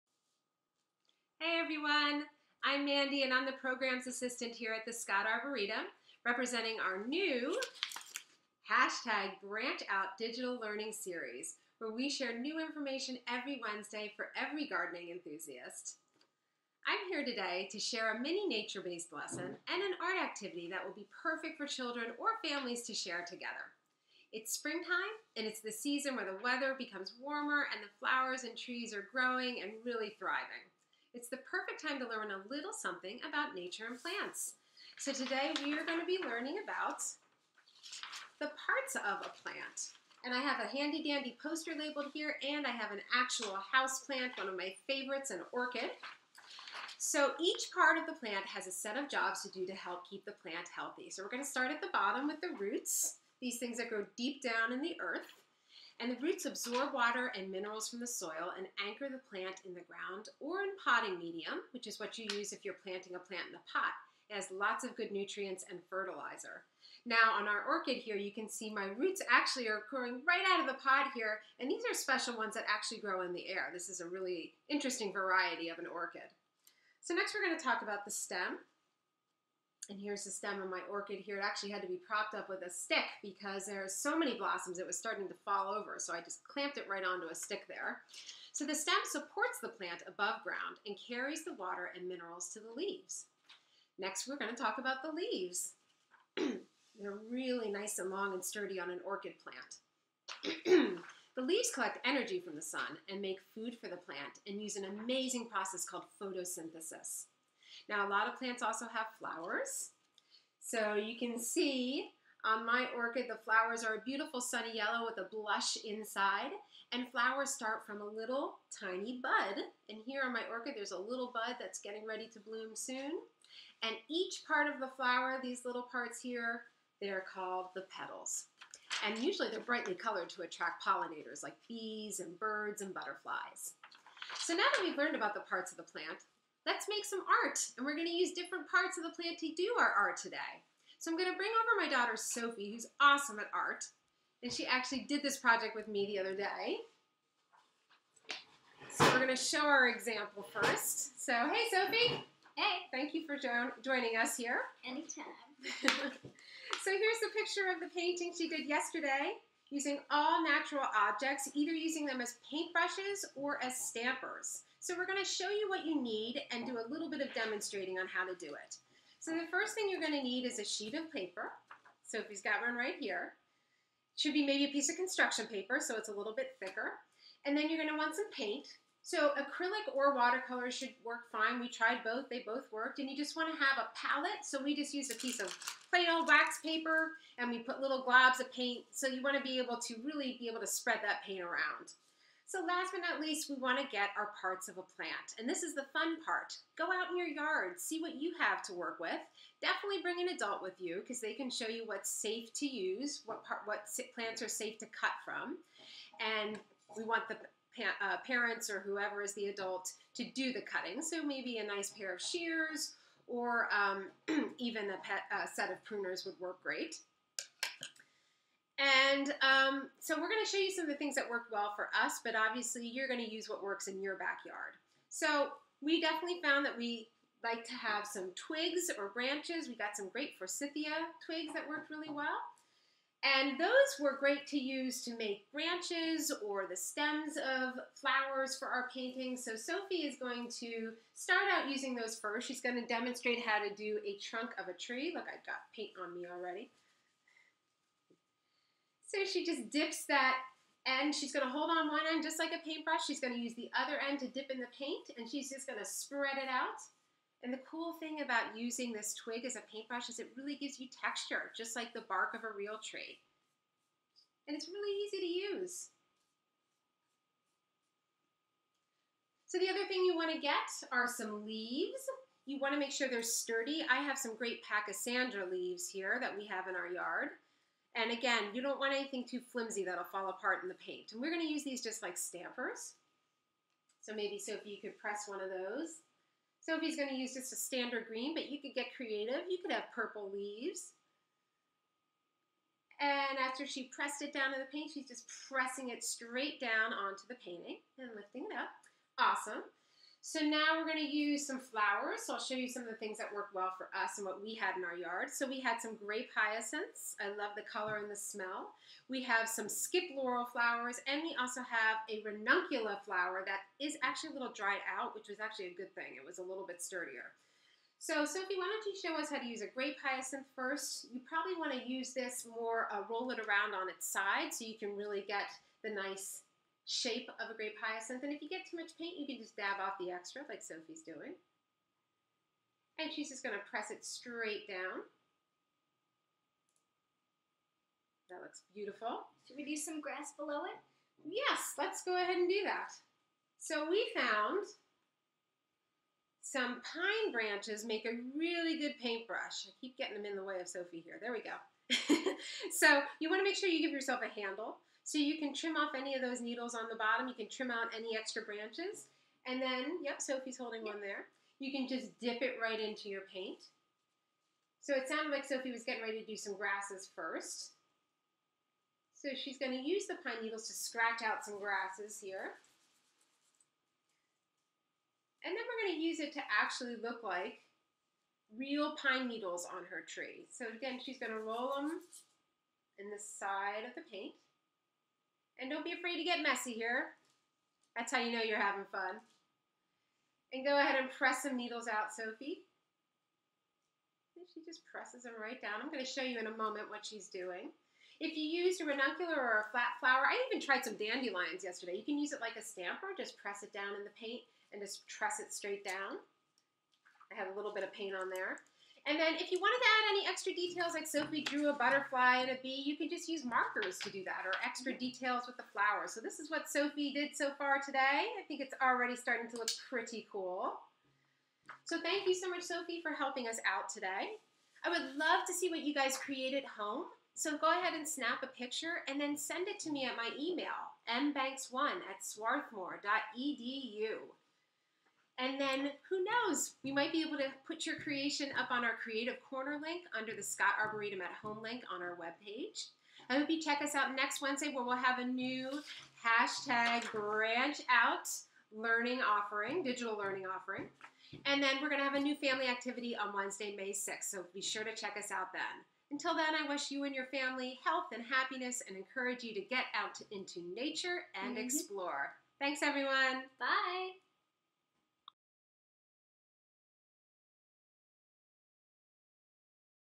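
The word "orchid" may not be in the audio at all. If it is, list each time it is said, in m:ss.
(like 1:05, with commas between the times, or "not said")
0:45, 1:07, 1:15, 1:20, 1:39, 1:52, 2:00.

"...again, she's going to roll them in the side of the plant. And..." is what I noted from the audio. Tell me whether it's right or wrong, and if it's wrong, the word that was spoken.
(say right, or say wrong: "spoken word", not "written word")
wrong: "paint", not "plant".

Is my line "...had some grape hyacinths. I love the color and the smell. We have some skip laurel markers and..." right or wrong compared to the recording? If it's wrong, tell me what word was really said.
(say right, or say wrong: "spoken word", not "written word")
wrong: "flowers", not "markers".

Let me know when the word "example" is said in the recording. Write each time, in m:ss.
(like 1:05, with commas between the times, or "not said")
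2:29.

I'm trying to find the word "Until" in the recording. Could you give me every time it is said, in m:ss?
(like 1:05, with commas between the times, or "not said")
7:36.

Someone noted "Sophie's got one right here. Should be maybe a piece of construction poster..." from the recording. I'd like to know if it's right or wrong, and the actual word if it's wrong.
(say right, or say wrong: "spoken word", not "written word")
wrong: "paper", not "poster".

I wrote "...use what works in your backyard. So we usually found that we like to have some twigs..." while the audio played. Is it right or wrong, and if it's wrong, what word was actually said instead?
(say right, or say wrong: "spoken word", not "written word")
wrong: "definitely", not "usually".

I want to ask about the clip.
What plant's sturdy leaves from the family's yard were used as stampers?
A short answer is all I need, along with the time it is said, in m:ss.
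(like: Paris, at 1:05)
Pachysandra, at 4:34.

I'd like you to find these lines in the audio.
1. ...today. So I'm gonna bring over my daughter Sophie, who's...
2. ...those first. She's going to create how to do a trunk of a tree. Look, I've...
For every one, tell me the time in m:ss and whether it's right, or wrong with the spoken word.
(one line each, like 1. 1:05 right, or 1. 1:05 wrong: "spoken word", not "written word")
1. 2:20 right
2. 4:01 wrong: "demonstrate", not "create".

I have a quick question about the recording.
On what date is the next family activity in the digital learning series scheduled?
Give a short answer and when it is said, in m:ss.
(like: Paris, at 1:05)
May 6th, at 7:33.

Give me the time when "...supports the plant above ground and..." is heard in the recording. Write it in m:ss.
1:29.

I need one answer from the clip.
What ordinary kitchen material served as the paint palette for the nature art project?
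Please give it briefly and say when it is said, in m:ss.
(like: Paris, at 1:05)
wax paper, at 3:06.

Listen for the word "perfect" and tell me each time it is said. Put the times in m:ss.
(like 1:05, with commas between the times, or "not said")
0:21, 0:31.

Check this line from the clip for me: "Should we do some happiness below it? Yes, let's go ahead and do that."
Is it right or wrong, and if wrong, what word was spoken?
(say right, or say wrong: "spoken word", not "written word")
wrong: "grass", not "happiness".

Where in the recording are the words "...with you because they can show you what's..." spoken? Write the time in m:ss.
3:20.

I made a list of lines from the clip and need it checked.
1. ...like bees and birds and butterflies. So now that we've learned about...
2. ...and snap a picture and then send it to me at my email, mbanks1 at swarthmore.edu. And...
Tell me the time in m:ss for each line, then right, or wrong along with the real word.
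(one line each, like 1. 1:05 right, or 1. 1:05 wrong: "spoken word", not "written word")
1. 2:11 right
2. 7:07 right.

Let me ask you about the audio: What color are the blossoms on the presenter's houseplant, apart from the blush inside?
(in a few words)
sunny yellow.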